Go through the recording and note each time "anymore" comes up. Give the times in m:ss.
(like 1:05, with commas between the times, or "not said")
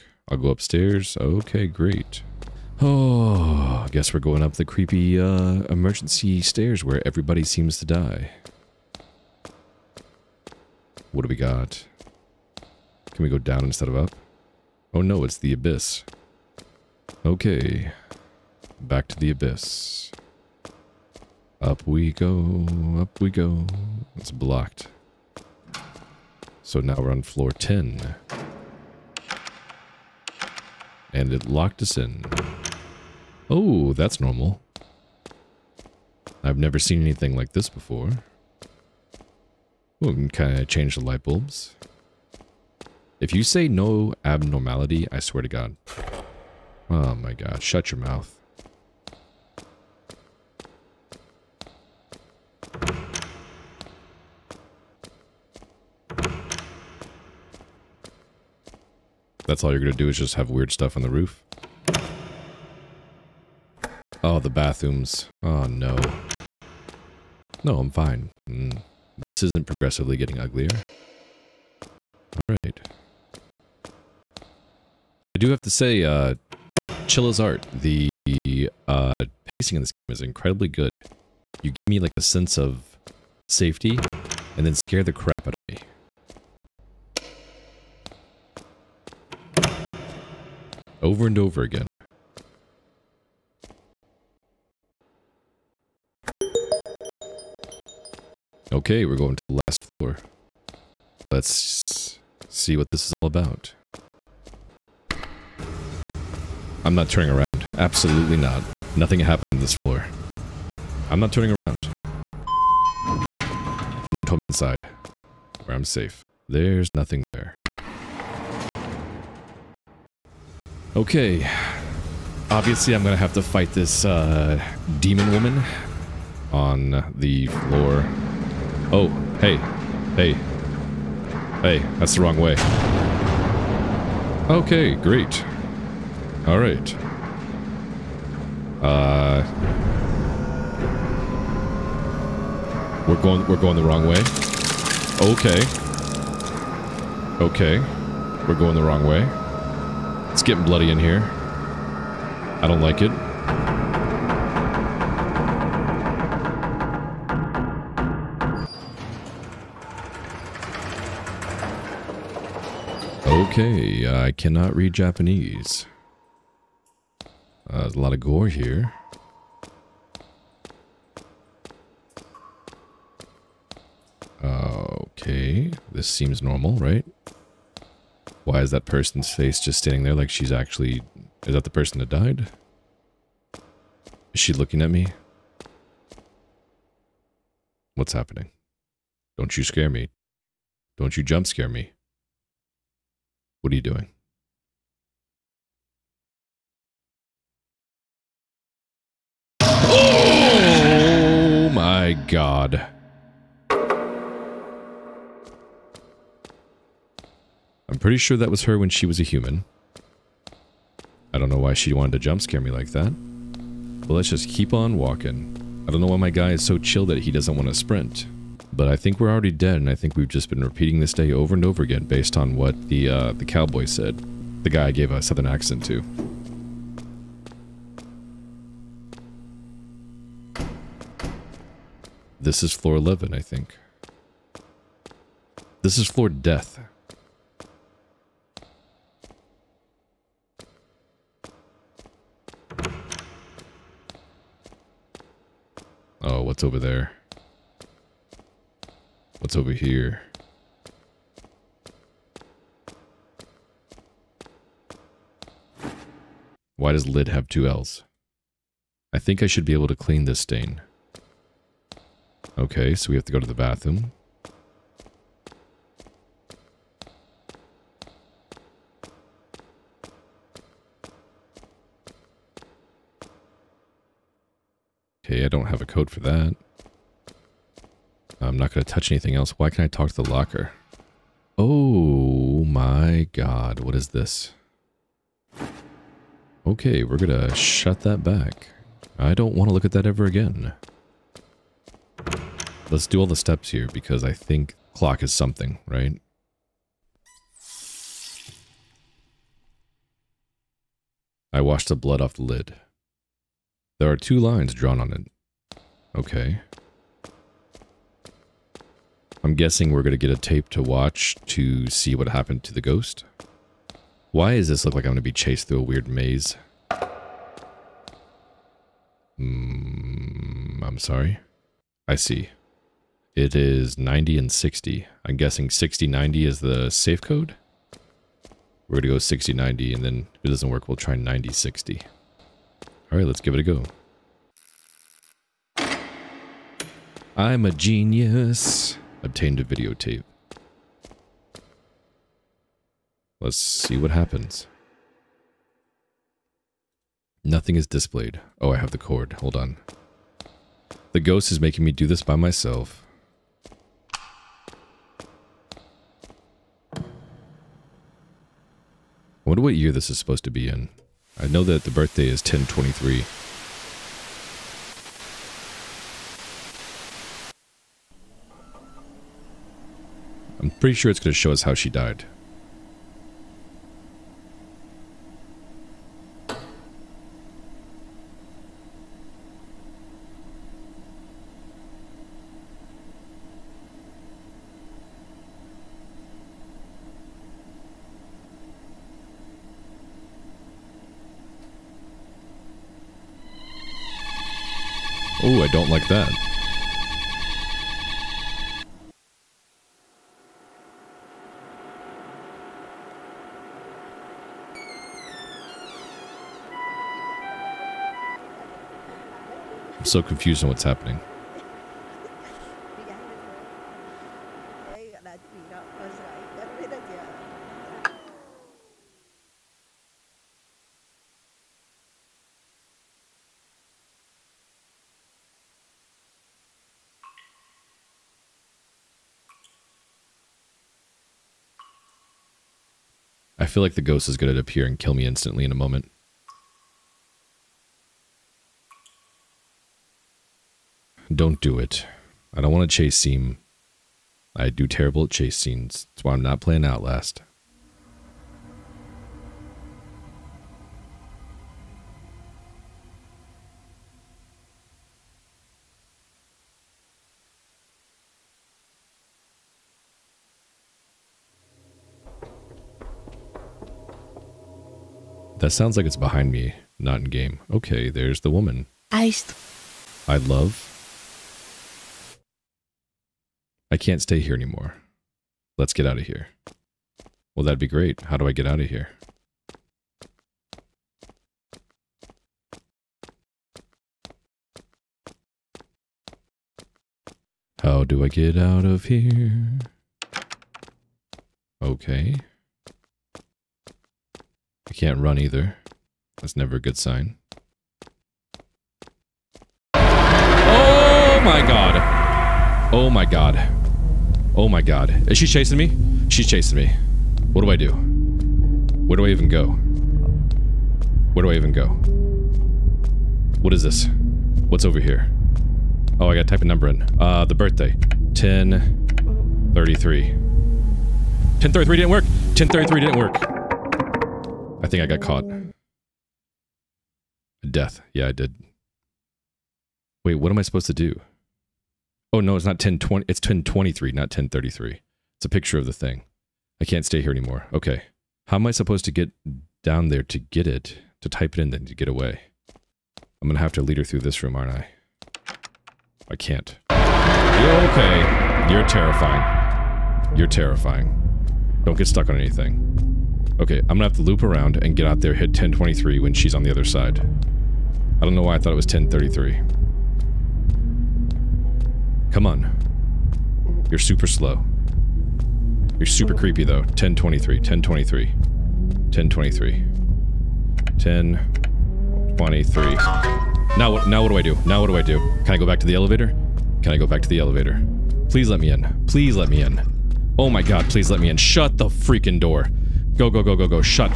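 7:54, 8:57.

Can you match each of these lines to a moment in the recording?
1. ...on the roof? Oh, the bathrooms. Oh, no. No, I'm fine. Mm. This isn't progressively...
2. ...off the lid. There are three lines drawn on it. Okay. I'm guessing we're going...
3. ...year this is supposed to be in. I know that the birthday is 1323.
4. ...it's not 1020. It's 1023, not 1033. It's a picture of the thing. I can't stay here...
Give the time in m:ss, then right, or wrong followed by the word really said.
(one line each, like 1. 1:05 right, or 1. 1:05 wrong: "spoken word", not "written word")
1. 1:00 right
2. 5:02 wrong: "two", not "three"
3. 5:59 wrong: "1023", not "1323"
4. 8:52 right.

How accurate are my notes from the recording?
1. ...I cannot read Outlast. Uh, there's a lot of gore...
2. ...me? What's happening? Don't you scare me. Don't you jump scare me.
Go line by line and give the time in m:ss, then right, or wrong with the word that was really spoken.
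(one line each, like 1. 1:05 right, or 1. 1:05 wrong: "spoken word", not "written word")
1. 2:44 wrong: "Japanese", not "Outlast"
2. 3:04 right.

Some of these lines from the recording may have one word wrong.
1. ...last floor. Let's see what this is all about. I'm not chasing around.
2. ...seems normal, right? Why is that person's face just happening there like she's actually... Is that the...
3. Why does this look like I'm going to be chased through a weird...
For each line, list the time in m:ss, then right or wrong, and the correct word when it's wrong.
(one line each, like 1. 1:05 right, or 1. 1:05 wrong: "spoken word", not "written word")
1. 1:39 wrong: "turning", not "chasing"
2. 2:56 wrong: "standing", not "happening"
3. 5:14 right.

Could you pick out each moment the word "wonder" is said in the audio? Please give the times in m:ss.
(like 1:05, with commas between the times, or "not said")
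5:59.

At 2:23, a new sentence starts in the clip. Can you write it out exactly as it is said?
We're going, we're going the wrong way.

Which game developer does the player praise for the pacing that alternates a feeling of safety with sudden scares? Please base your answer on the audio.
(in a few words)
Chilla's Art.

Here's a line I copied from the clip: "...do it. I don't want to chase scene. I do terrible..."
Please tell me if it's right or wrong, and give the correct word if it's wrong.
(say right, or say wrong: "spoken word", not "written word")
right.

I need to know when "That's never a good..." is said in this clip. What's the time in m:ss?
8:16.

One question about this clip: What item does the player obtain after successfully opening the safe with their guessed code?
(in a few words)
a videotape.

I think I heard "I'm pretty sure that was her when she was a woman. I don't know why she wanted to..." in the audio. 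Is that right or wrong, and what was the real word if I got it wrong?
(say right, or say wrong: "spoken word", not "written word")
wrong: "human", not "woman".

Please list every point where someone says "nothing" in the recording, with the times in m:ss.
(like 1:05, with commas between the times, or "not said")
1:48, 1:56, 5:47.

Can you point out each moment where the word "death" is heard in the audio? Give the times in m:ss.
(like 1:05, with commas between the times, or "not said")
3:56, 8:47.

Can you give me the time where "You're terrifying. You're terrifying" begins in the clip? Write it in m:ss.
9:08.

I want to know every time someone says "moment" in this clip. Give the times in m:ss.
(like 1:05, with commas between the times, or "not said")
7:15.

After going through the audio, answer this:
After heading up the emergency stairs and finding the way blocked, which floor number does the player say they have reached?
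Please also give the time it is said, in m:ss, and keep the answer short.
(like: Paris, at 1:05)
10, at 0:27.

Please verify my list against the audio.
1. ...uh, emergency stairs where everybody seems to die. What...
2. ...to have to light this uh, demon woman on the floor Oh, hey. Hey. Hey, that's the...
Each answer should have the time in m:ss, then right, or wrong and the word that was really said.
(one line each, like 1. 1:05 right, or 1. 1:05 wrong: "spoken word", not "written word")
1. 0:05 right
2. 2:03 wrong: "fight", not "light".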